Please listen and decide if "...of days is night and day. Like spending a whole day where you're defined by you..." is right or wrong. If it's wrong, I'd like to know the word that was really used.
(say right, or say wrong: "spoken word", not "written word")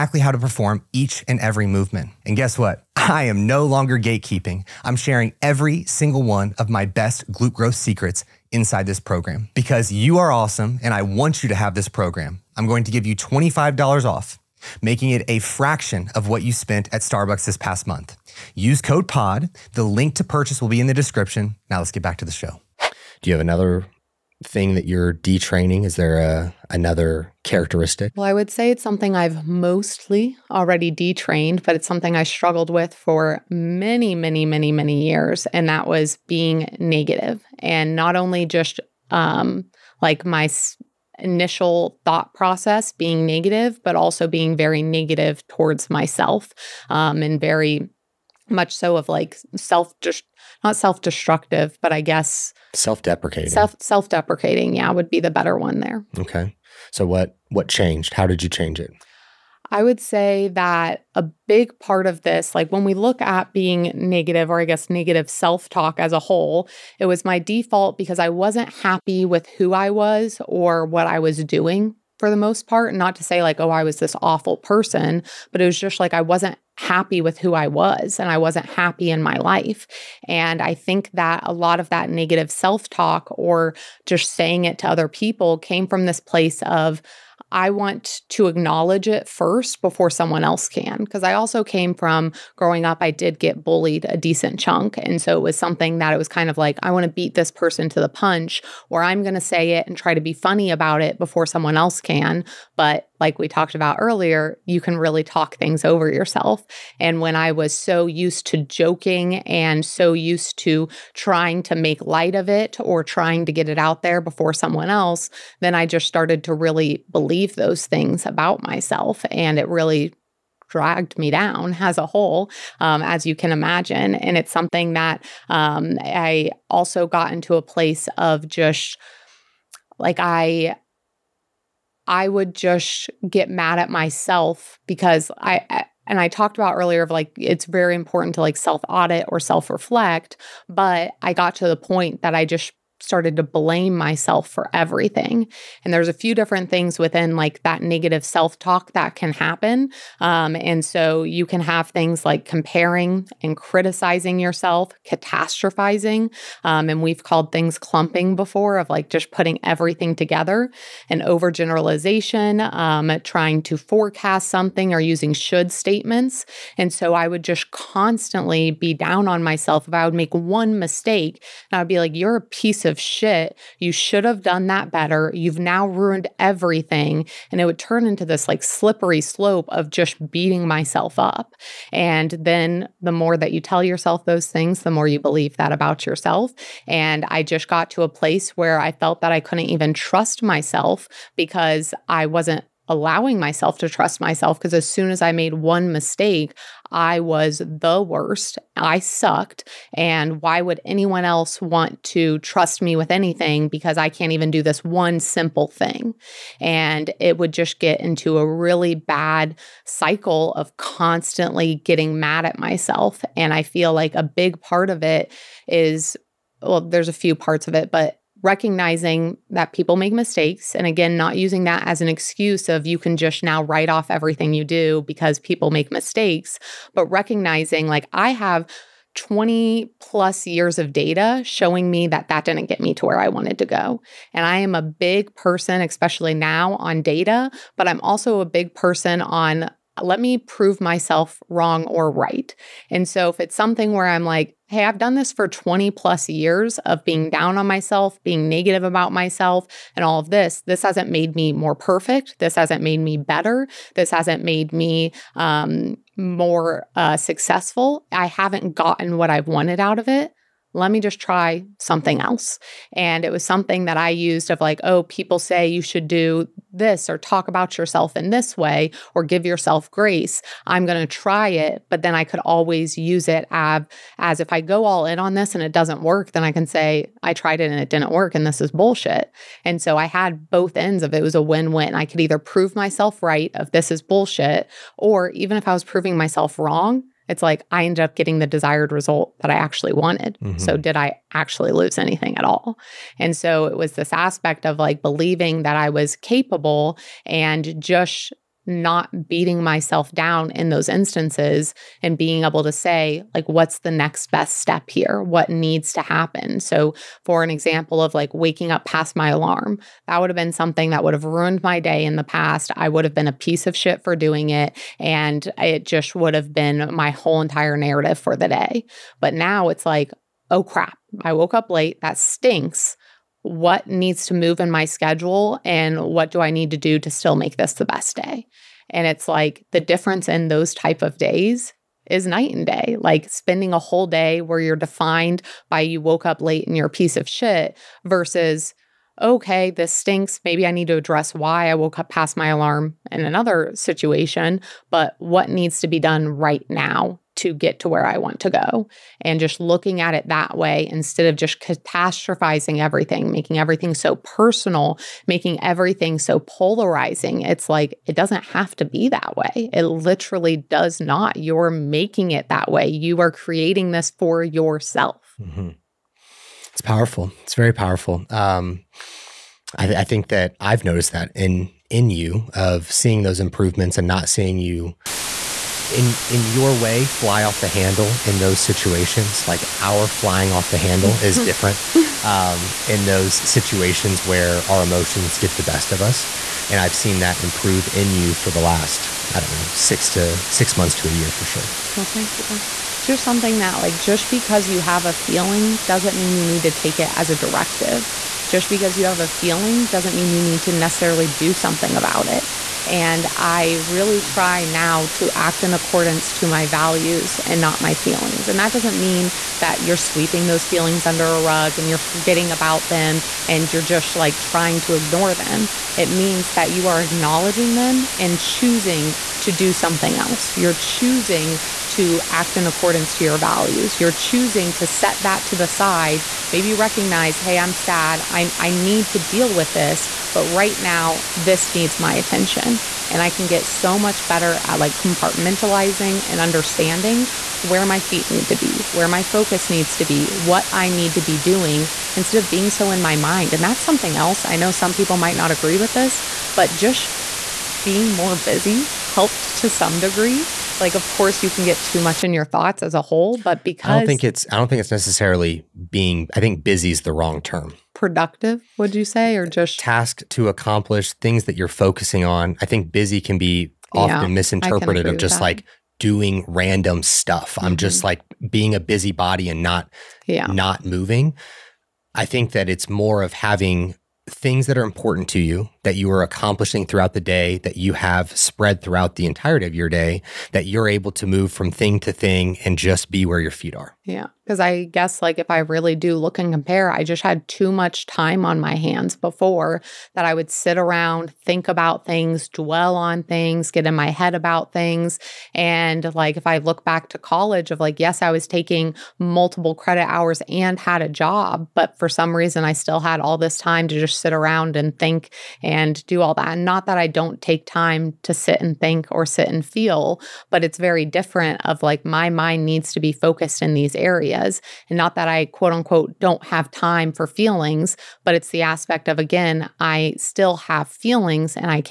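right.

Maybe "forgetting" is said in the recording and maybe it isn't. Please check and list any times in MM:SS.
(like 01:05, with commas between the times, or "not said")
06:51.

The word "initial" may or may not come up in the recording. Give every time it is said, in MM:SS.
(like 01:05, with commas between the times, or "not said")
00:41.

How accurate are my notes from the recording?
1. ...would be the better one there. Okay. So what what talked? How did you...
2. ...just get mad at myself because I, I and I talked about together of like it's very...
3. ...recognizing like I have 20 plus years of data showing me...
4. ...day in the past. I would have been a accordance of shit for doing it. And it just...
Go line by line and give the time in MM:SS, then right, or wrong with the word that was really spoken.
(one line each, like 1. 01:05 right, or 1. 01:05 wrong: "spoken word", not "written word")
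1. 00:54 wrong: "changed", not "talked"
2. 02:12 wrong: "earlier", not "together"
3. 03:47 right
4. 05:11 wrong: "piece", not "accordance".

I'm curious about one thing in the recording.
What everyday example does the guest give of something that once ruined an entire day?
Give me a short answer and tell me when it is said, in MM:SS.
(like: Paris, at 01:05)
waking up past my alarm, at 05:08.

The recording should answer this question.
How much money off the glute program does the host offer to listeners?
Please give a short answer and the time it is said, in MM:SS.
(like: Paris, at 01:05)
$25, at 00:13.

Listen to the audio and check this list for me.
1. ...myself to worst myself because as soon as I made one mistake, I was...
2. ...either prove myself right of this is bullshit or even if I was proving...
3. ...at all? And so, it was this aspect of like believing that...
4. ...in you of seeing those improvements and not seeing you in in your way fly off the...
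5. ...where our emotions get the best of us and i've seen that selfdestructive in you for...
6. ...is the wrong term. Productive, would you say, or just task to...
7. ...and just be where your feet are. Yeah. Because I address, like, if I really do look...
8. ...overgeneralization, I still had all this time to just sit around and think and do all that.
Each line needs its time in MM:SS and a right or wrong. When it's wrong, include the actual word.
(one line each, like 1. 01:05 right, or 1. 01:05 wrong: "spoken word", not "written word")
1. 03:13 wrong: "trust", not "worst"
2. 04:42 right
3. 04:52 right
4. 06:11 right
5. 06:24 wrong: "improve", not "selfdestructive"
6. 07:36 right
7. 08:02 wrong: "guess", not "address"
8. 08:22 wrong: "reason", not "overgeneralization".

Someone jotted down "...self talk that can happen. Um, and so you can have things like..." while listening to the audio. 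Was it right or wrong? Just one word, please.
right.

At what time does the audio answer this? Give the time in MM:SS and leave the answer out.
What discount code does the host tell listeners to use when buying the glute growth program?
00:19.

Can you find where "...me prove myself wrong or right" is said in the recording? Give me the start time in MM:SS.
04:00.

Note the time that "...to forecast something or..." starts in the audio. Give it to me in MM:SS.
02:43.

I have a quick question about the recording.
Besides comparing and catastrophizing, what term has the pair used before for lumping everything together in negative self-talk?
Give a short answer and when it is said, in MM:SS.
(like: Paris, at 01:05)
clumping, at 02:37.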